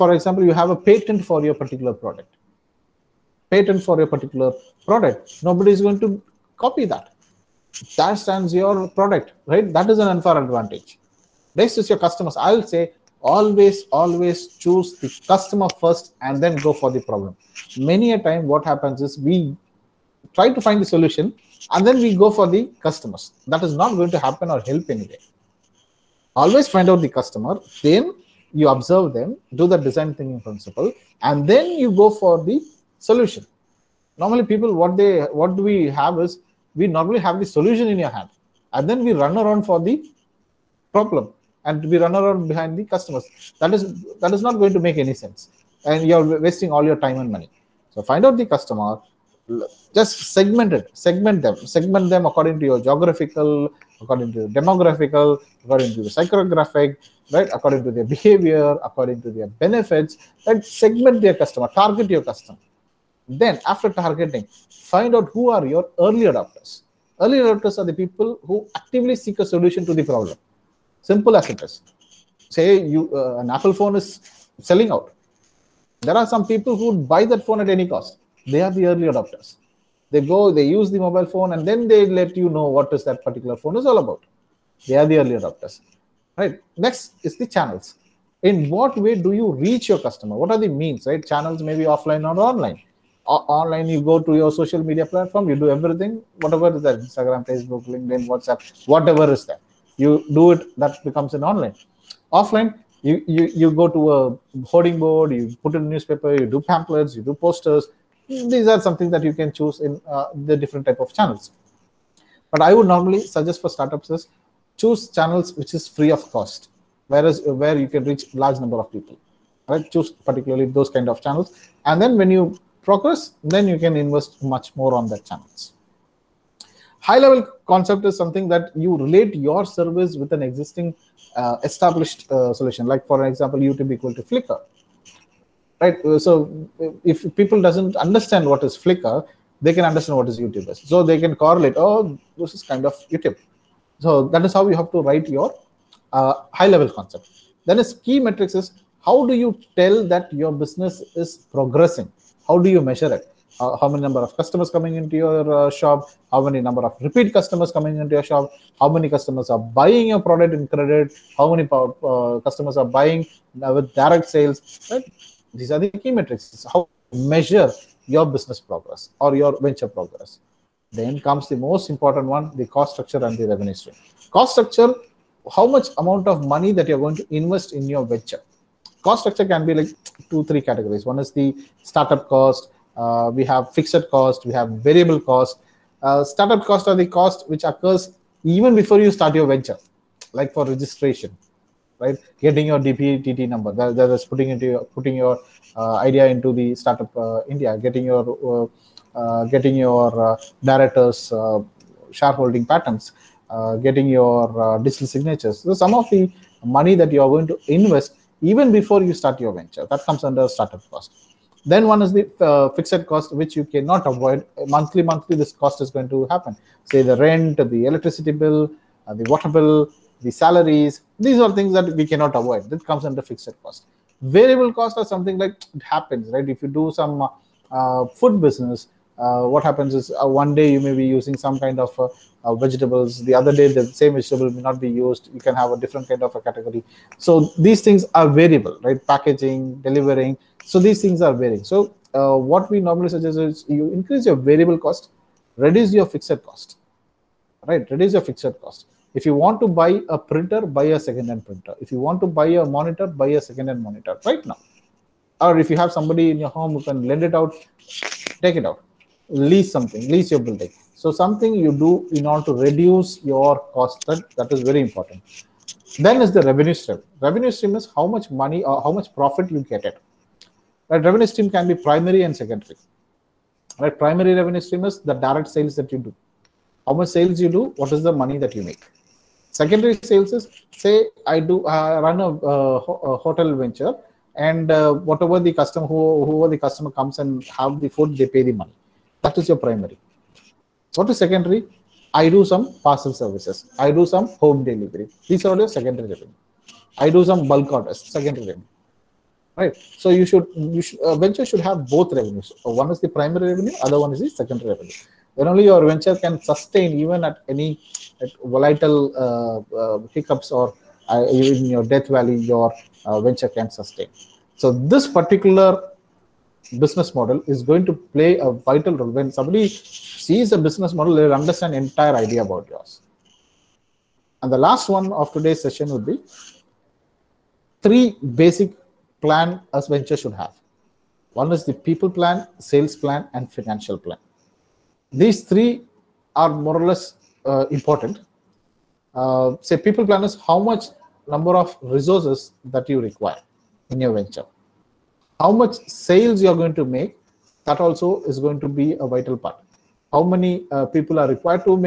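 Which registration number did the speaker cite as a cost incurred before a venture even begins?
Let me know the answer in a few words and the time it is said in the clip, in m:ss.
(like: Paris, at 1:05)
DPIIT number, at 3:12.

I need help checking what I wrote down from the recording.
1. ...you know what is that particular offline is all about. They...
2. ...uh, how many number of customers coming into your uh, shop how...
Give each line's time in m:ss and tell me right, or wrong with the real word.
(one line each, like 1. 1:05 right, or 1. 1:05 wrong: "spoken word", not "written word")
1. 1:22 wrong: "phone", not "offline"
2. 2:33 right.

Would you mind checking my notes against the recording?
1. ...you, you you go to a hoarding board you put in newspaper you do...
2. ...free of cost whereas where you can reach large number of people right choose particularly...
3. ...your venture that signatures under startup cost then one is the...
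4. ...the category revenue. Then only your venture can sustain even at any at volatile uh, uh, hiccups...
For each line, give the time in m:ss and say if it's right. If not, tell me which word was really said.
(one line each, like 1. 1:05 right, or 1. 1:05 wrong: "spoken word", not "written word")
1. 1:43 right
2. 1:55 right
3. 3:29 wrong: "comes", not "signatures"
4. 5:04 wrong: "secondary", not "category".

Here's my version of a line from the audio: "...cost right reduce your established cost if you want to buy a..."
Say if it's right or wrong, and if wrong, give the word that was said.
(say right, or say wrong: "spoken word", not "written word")
wrong: "fixed", not "established".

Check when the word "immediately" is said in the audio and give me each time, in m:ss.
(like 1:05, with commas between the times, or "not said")
not said.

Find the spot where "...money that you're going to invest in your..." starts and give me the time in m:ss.
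2:56.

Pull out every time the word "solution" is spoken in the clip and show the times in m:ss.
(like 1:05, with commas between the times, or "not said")
0:20, 0:33, 0:37, 1:09, 2:12.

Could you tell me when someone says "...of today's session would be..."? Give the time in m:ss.
5:25.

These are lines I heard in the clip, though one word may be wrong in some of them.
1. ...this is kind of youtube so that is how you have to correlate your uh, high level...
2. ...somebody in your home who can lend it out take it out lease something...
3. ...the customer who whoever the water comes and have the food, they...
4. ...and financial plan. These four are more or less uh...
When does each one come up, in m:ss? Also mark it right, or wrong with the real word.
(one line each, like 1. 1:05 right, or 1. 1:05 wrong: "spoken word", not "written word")
1. 2:22 wrong: "write", not "correlate"
2. 4:15 right
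3. 4:45 wrong: "customer", not "water"
4. 5:33 wrong: "three", not "four".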